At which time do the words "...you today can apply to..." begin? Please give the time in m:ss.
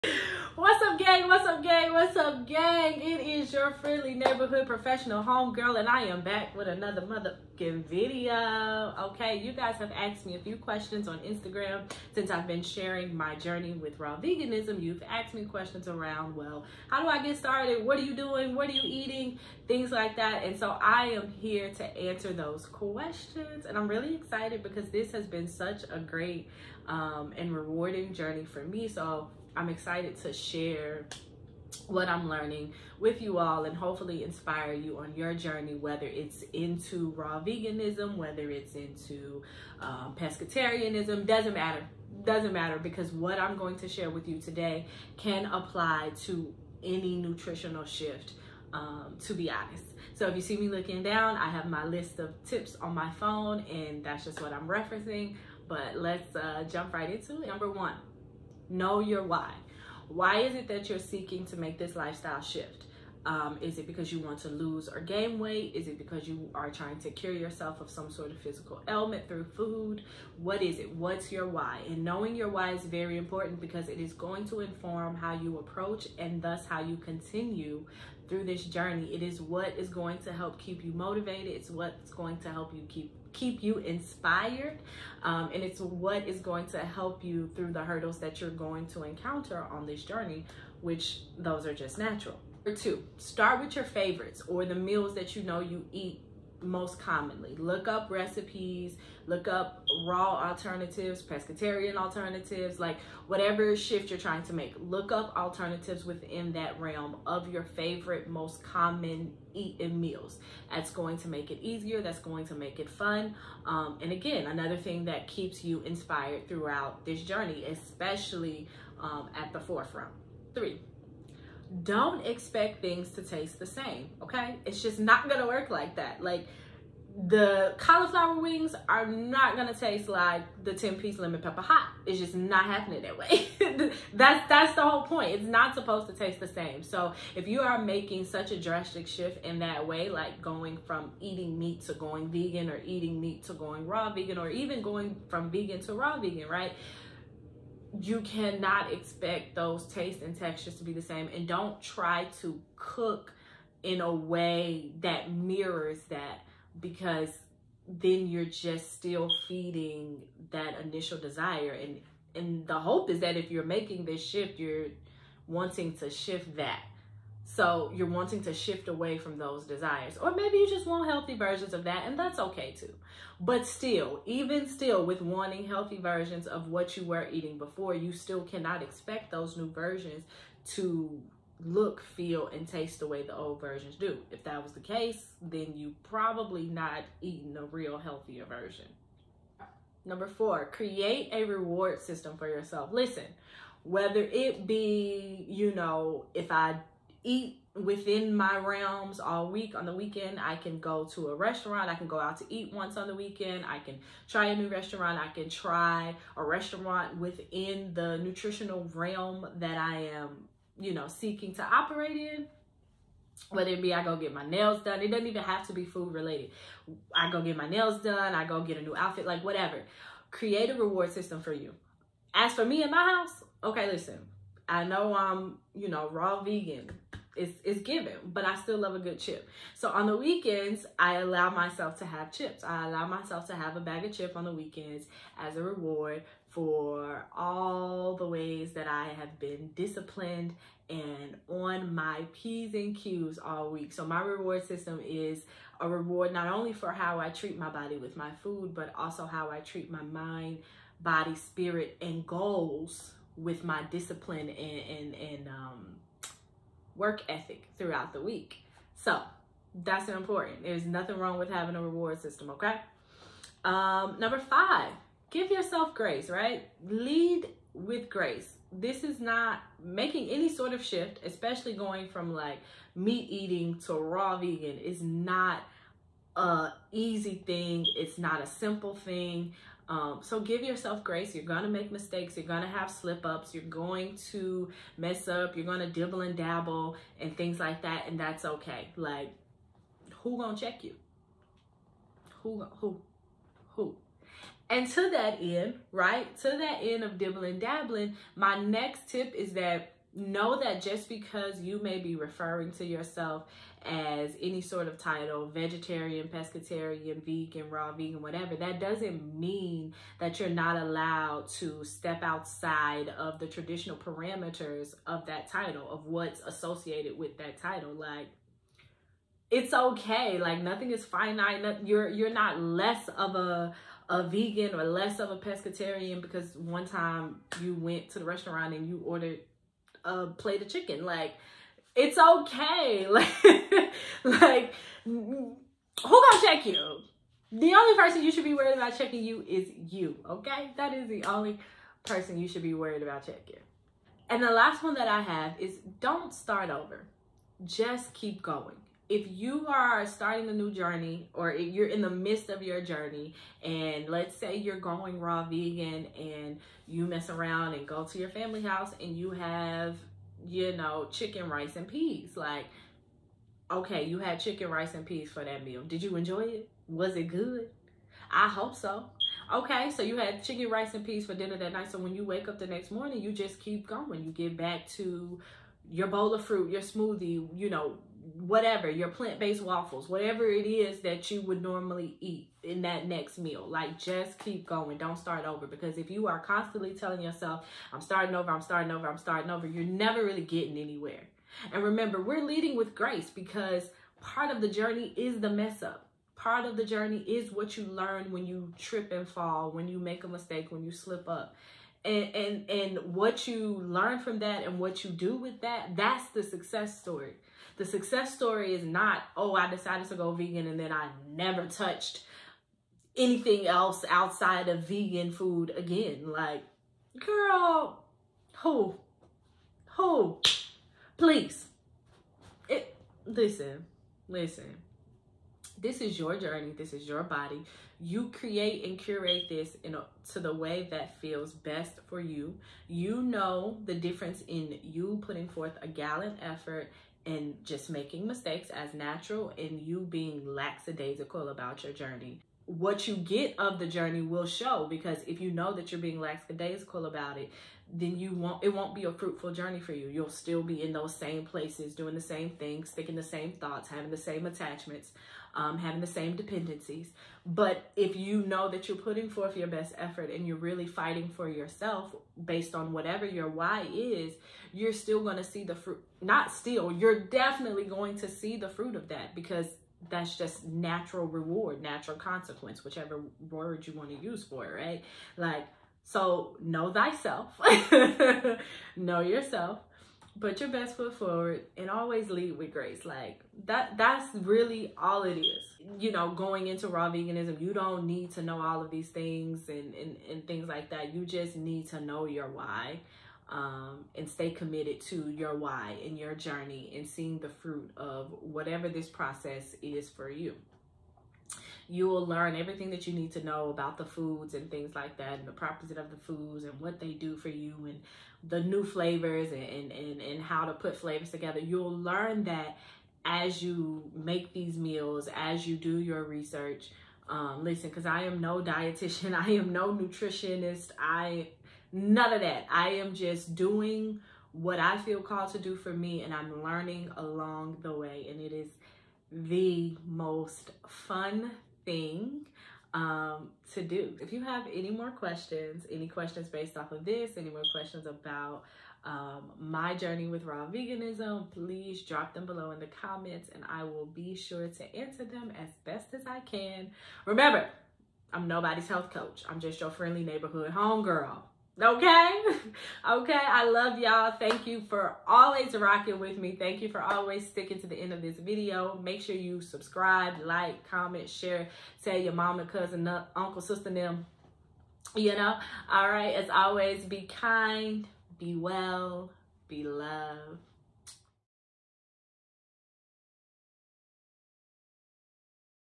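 0:44.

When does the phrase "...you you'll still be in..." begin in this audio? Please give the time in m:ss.
7:29.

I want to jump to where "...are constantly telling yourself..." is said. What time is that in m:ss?
6:26.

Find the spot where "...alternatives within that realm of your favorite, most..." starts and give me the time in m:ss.
1:45.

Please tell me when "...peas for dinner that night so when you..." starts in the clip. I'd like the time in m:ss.
6:11.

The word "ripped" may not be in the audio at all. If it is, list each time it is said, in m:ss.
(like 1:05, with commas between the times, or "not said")
not said.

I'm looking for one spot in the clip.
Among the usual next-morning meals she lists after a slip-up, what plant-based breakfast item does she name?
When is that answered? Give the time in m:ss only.
6:19.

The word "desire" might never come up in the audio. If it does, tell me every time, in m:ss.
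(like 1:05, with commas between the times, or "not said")
2:41, 2:49.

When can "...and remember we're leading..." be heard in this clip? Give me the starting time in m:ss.
6:31.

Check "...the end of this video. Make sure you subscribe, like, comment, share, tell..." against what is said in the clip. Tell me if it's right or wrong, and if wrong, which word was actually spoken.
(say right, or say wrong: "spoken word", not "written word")
right.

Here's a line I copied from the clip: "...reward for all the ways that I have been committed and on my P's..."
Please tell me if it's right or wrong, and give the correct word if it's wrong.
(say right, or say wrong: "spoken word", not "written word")
wrong: "disciplined", not "committed".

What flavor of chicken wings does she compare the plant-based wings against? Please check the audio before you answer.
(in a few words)
lemon pepper.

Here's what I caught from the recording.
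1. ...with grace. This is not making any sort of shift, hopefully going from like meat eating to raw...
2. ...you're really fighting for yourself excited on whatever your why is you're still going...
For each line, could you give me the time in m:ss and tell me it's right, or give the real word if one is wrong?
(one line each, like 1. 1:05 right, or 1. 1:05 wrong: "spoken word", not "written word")
1. 4:27 wrong: "especially", not "hopefully"
2. 7:40 wrong: "based", not "excited".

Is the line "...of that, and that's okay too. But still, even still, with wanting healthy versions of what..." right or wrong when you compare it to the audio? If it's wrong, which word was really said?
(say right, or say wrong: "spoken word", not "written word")
right.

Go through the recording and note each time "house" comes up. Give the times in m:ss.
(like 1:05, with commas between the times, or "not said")
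3:43, 5:58.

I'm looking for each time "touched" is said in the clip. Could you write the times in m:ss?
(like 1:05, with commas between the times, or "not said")
6:51.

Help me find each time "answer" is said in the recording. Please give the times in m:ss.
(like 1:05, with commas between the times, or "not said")
0:21, 9:04.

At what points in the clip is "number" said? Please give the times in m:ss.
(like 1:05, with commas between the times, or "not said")
0:57, 1:32, 3:10, 4:24.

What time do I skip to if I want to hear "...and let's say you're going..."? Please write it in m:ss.
5:53.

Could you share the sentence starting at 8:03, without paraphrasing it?
Like that, that's really all it is.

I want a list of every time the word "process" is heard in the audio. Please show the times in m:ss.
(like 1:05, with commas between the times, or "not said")
8:19.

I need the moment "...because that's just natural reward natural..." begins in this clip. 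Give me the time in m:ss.
7:49.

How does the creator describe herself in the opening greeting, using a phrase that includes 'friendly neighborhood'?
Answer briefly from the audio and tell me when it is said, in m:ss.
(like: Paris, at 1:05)
professional homegirl, at 0:04.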